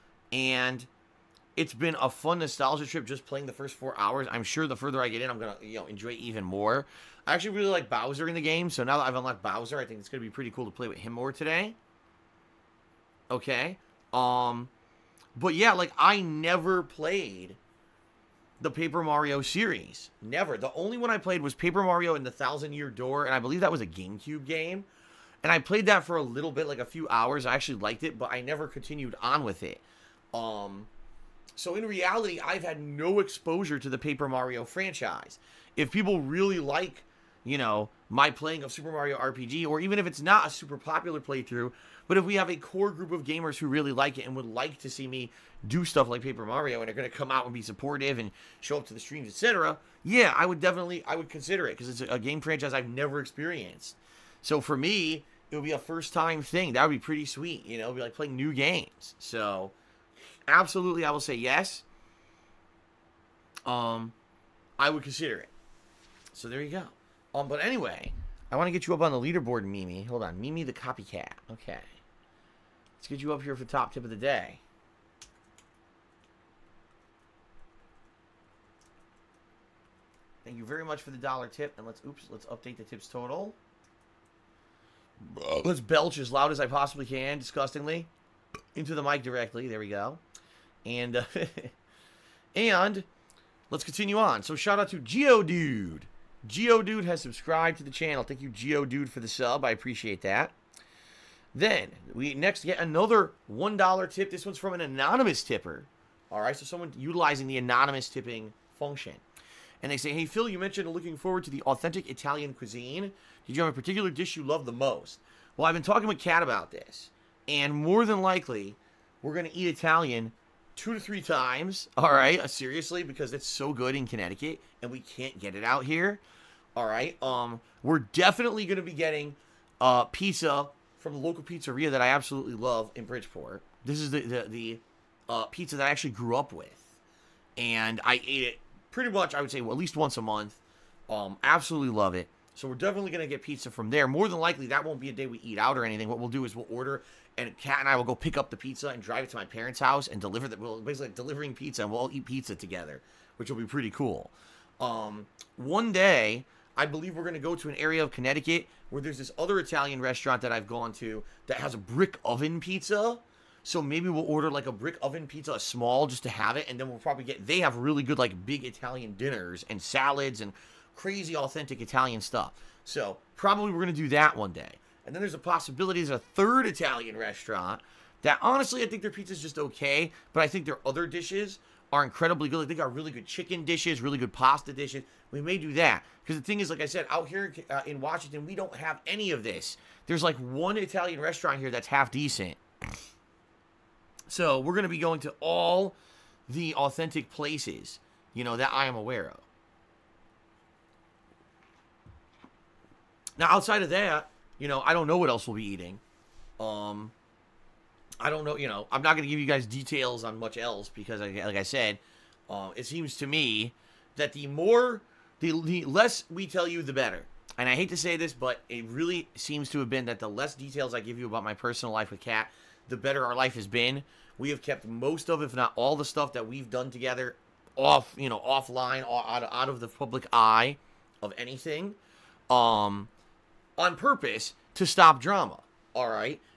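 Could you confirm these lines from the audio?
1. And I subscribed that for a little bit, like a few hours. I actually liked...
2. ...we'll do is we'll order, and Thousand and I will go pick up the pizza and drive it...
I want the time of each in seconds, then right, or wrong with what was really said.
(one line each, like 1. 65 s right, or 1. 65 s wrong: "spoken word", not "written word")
1. 25 s wrong: "played", not "subscribed"
2. 146 s wrong: "Kat", not "Thousand".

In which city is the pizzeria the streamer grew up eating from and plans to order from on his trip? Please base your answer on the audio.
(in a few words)
Bridgeport.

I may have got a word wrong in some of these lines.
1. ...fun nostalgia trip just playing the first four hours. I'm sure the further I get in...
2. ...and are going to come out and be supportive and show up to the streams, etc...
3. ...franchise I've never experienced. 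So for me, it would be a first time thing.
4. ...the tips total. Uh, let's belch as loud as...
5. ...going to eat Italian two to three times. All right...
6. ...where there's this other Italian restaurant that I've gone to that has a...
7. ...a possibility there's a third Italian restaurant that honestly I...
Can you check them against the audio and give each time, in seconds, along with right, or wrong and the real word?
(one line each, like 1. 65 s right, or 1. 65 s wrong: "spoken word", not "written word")
1. 2 s right
2. 46 s right
3. 52 s right
4. 82 s right
5. 119 s right
6. 158 s right
7. 175 s right.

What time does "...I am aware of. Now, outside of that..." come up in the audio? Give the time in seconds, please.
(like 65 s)
198 s.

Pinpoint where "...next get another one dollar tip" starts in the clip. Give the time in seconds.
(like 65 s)
102 s.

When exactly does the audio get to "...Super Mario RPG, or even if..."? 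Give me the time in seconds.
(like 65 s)
38 s.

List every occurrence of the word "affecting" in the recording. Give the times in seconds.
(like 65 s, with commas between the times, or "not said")
not said.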